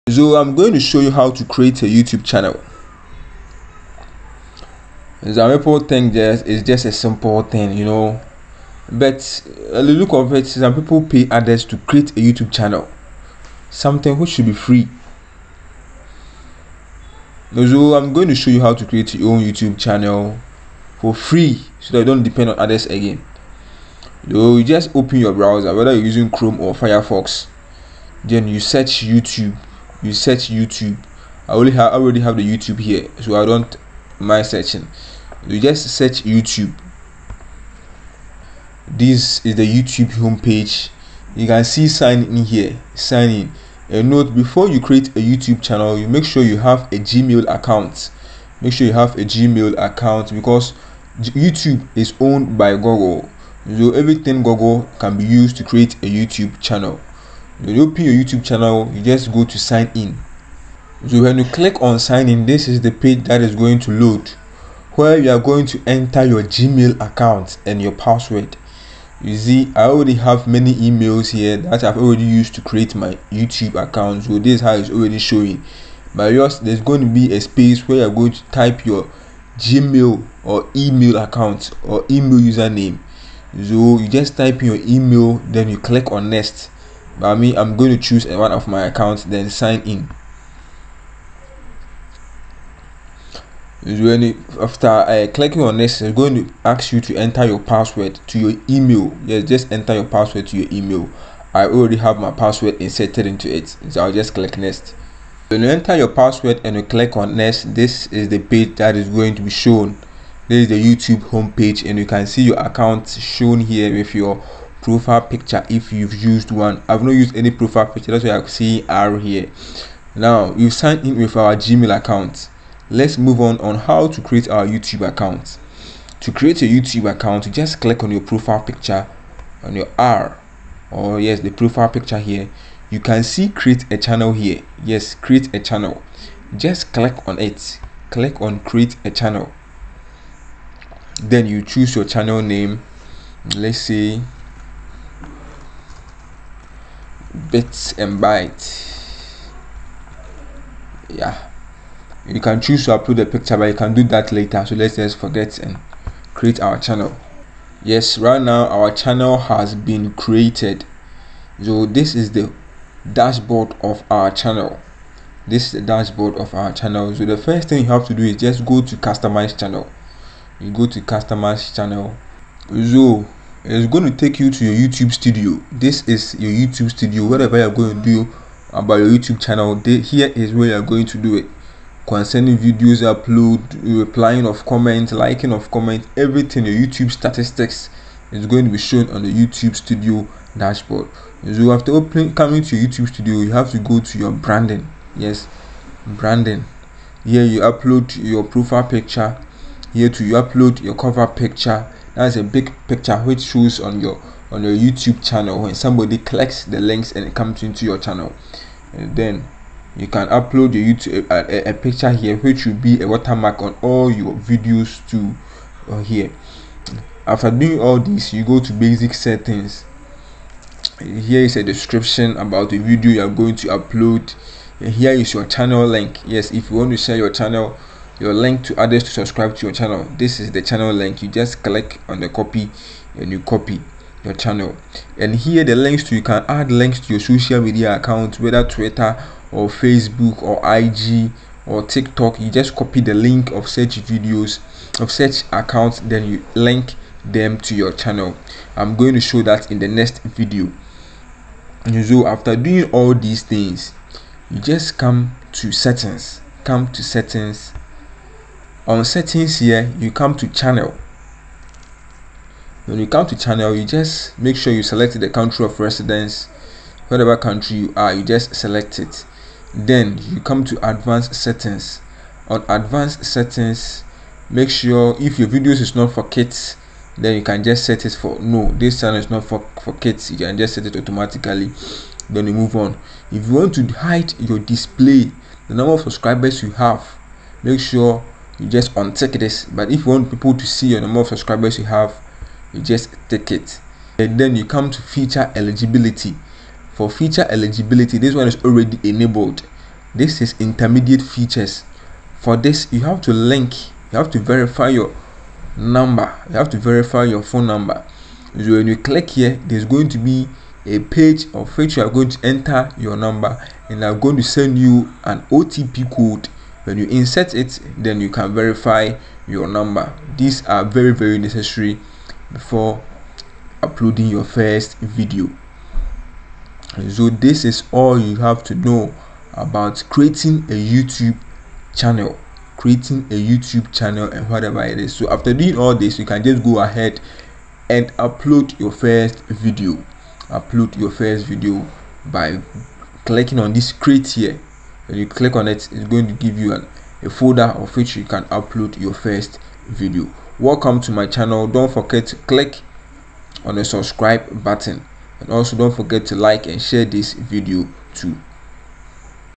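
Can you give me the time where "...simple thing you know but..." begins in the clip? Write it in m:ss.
0:06.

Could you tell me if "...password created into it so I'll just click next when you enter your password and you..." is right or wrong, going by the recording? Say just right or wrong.
wrong.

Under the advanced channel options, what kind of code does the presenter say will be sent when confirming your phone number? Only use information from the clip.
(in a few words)
OTP code.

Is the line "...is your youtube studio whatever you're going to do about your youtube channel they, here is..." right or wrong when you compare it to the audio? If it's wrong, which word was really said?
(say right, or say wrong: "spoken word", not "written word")
right.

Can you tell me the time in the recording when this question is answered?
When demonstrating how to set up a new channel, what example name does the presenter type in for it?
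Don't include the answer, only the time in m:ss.
2:27.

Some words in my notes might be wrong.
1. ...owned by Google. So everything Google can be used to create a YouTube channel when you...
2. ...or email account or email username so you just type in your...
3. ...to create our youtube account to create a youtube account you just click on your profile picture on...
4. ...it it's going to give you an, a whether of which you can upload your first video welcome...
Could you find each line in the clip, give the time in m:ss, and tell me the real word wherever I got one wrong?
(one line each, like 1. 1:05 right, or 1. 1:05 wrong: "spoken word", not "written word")
1. 0:52 right
2. 1:20 right
3. 2:04 right
4. 5:45 wrong: "folder", not "whether".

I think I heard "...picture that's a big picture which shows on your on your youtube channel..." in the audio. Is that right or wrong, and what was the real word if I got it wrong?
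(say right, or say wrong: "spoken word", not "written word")
right.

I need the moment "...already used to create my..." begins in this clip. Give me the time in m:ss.
1:11.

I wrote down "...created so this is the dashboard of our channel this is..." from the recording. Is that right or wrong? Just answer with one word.
right.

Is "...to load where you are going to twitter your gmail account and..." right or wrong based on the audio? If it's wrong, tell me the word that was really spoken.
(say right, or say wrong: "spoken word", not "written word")
wrong: "enter", not "twitter".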